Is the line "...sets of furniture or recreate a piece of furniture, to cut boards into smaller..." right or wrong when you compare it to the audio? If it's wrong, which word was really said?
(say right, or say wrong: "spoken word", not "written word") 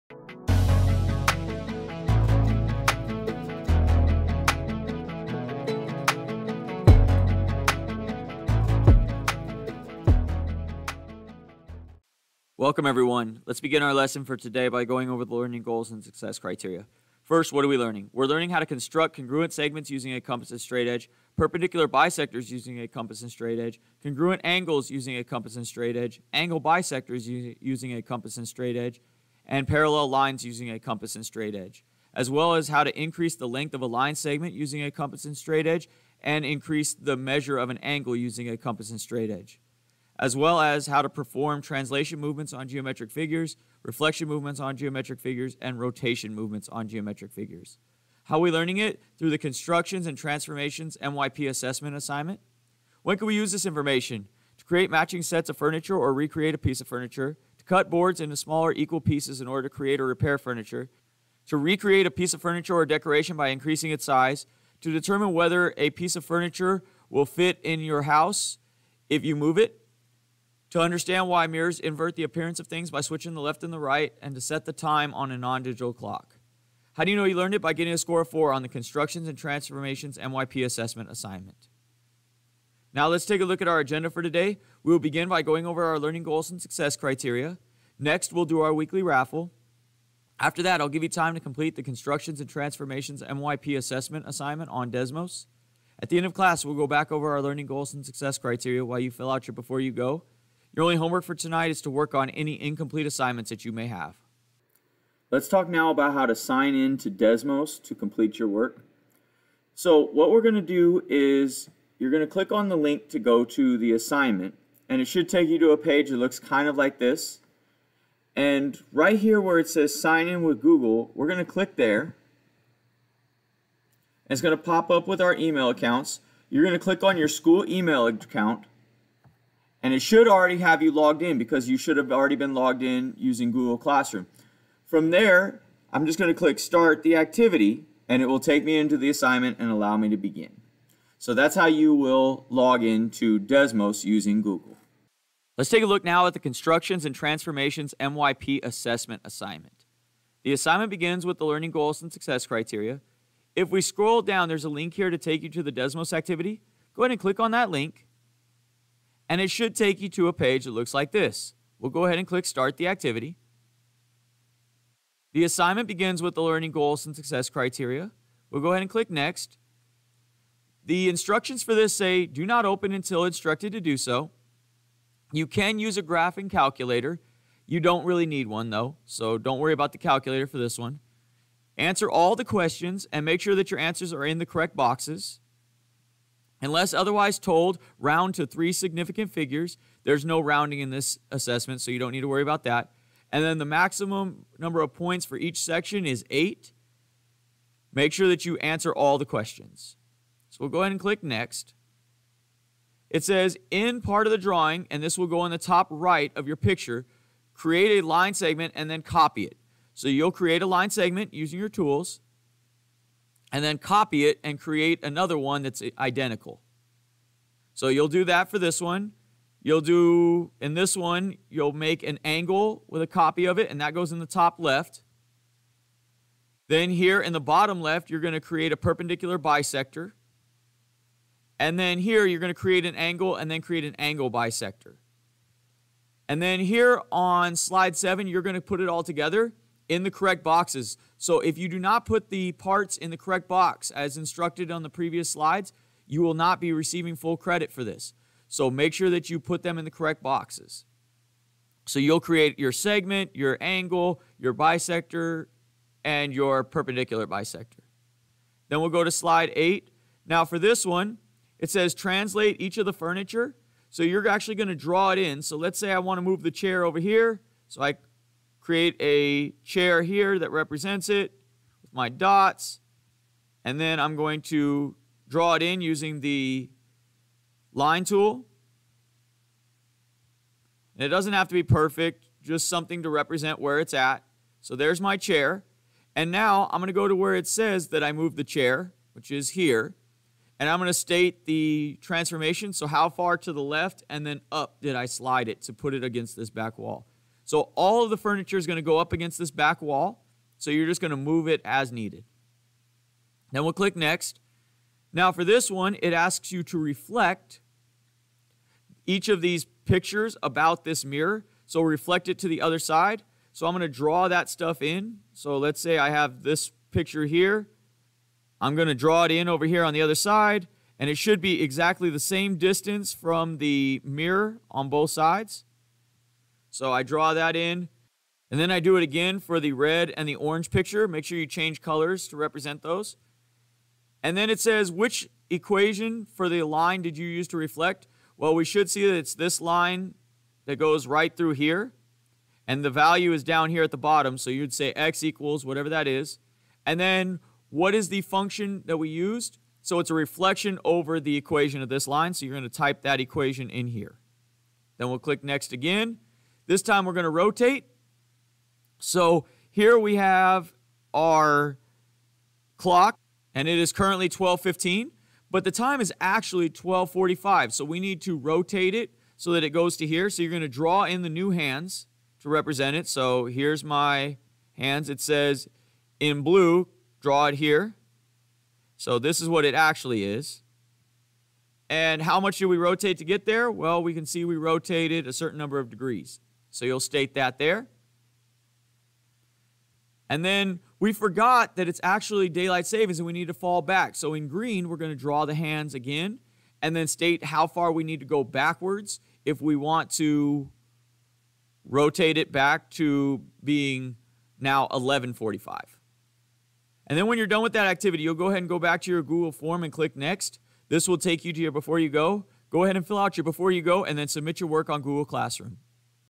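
right.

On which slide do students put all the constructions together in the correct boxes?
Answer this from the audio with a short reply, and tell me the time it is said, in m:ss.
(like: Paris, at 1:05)
slide seven, at 3:57.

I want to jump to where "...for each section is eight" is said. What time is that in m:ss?
3:15.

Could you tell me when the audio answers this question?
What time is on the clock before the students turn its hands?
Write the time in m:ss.
6:04.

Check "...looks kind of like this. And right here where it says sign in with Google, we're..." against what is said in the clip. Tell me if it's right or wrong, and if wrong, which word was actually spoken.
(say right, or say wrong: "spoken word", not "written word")
right.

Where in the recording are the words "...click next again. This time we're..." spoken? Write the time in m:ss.
5:55.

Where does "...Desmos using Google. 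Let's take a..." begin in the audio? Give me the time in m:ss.
2:23.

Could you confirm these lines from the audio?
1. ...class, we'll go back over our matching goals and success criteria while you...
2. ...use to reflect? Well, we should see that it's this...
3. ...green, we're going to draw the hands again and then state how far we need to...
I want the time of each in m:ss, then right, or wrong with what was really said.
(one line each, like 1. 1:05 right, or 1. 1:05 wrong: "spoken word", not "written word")
1. 1:36 wrong: "learning", not "matching"
2. 5:37 right
3. 6:34 right.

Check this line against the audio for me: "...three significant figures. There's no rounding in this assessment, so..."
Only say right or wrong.
right.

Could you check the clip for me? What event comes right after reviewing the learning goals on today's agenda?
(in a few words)
weekly raffle.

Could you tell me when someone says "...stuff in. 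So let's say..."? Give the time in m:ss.
5:14.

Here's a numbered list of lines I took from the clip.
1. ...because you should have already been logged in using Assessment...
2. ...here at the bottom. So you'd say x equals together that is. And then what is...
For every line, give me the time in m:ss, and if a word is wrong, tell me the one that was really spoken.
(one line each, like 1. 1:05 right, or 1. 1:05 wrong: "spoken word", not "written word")
1. 2:11 wrong: "Google", not "Assessment"
2. 5:43 wrong: "whatever", not "together".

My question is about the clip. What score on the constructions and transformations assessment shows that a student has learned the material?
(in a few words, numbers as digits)
4.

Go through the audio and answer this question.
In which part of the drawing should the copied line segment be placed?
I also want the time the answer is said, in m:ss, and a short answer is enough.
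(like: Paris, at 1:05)
top right, at 3:25.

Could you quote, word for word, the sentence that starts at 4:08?
So make sure that you put them in the correct boxes.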